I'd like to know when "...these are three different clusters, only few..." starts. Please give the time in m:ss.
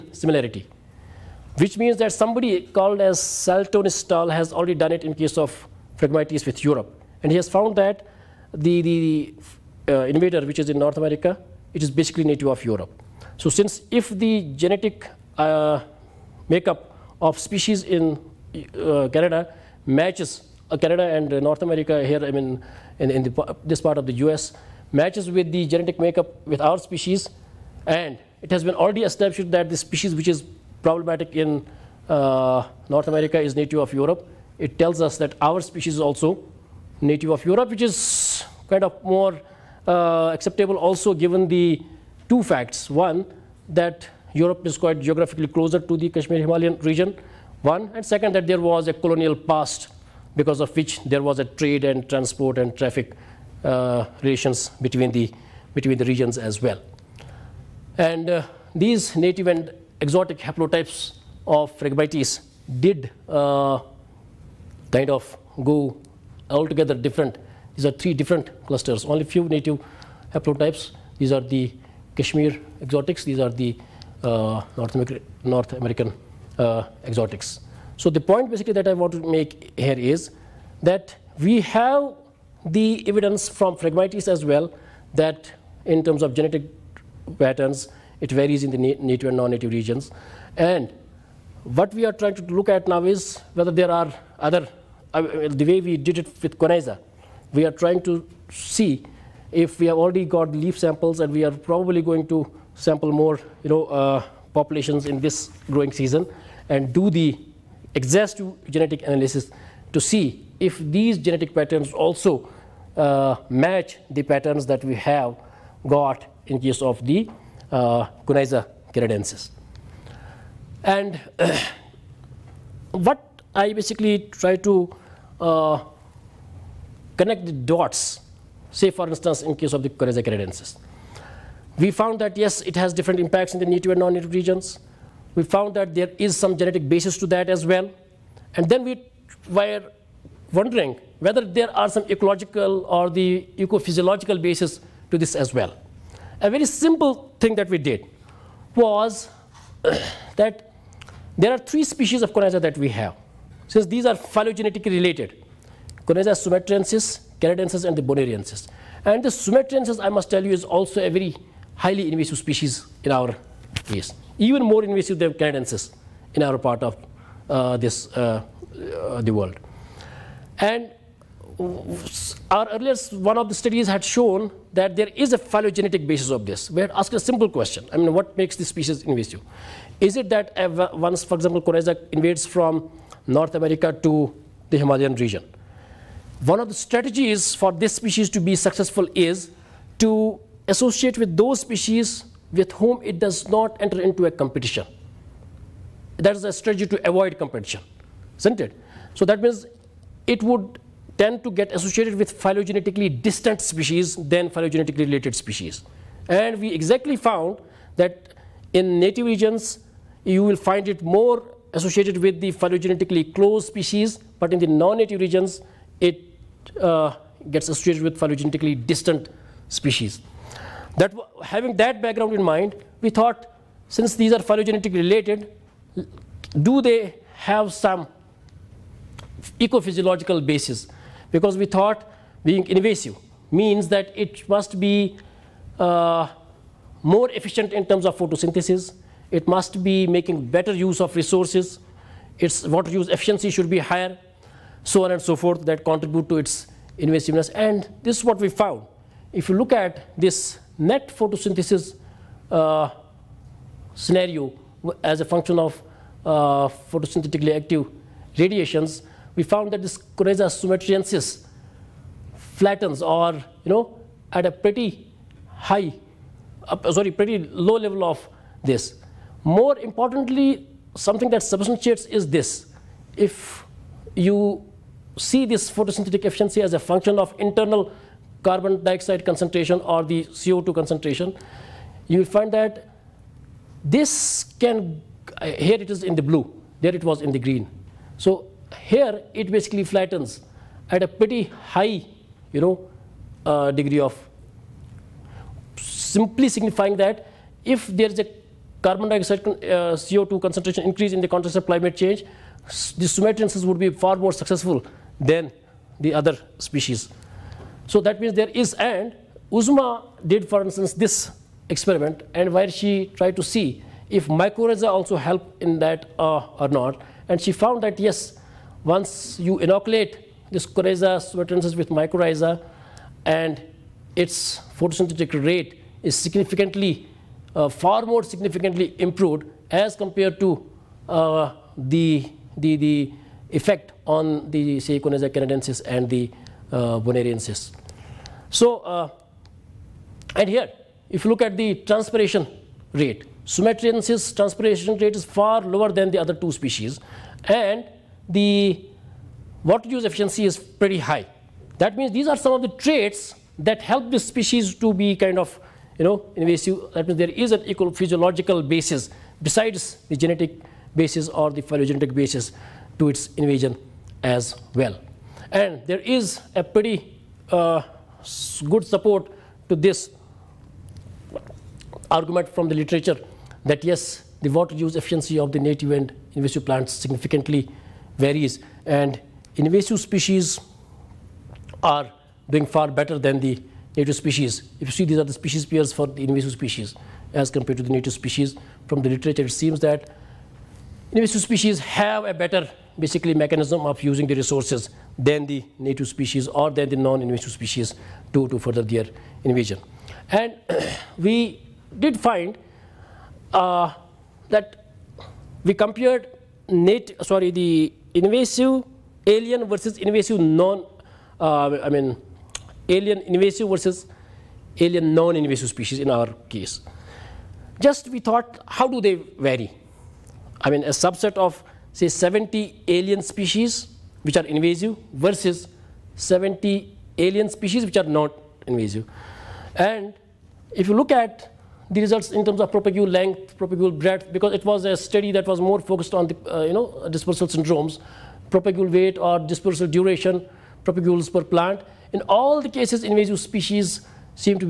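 1:07.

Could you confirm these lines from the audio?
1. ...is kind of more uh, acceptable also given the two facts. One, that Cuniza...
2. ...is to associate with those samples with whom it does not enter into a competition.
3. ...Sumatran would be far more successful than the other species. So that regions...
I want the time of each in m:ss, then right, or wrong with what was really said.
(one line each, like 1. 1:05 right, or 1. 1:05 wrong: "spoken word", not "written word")
1. 0:37 wrong: "Europe", not "Cuniza"
2. 3:09 wrong: "species", not "samples"
3. 5:03 wrong: "means", not "regions".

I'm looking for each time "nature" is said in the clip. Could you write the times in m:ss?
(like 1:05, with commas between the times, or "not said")
not said.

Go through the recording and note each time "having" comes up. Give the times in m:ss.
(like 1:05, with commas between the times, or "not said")
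3:41.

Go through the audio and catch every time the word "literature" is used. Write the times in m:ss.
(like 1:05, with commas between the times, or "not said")
6:12, 6:29.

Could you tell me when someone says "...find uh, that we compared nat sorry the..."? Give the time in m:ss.
6:42.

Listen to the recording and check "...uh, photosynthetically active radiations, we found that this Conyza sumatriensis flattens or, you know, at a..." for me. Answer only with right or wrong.
right.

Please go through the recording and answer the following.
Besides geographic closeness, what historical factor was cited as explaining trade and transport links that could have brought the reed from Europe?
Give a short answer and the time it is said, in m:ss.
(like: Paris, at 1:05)
colonial past, at 0:48.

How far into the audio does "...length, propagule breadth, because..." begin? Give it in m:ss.
7:13.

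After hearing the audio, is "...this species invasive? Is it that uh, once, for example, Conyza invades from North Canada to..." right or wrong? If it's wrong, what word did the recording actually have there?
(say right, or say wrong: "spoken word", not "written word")
wrong: "America", not "Canada".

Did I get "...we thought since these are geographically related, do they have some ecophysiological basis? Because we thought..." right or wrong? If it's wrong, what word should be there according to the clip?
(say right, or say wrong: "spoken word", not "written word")
wrong: "phylogenetically", not "geographically".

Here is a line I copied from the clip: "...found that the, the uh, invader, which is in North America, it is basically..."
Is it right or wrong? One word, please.
right.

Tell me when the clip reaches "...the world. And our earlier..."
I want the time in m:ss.
2:49.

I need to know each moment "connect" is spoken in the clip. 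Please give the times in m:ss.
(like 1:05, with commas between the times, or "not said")
2:07.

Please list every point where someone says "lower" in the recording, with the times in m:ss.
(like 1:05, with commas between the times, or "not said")
5:45.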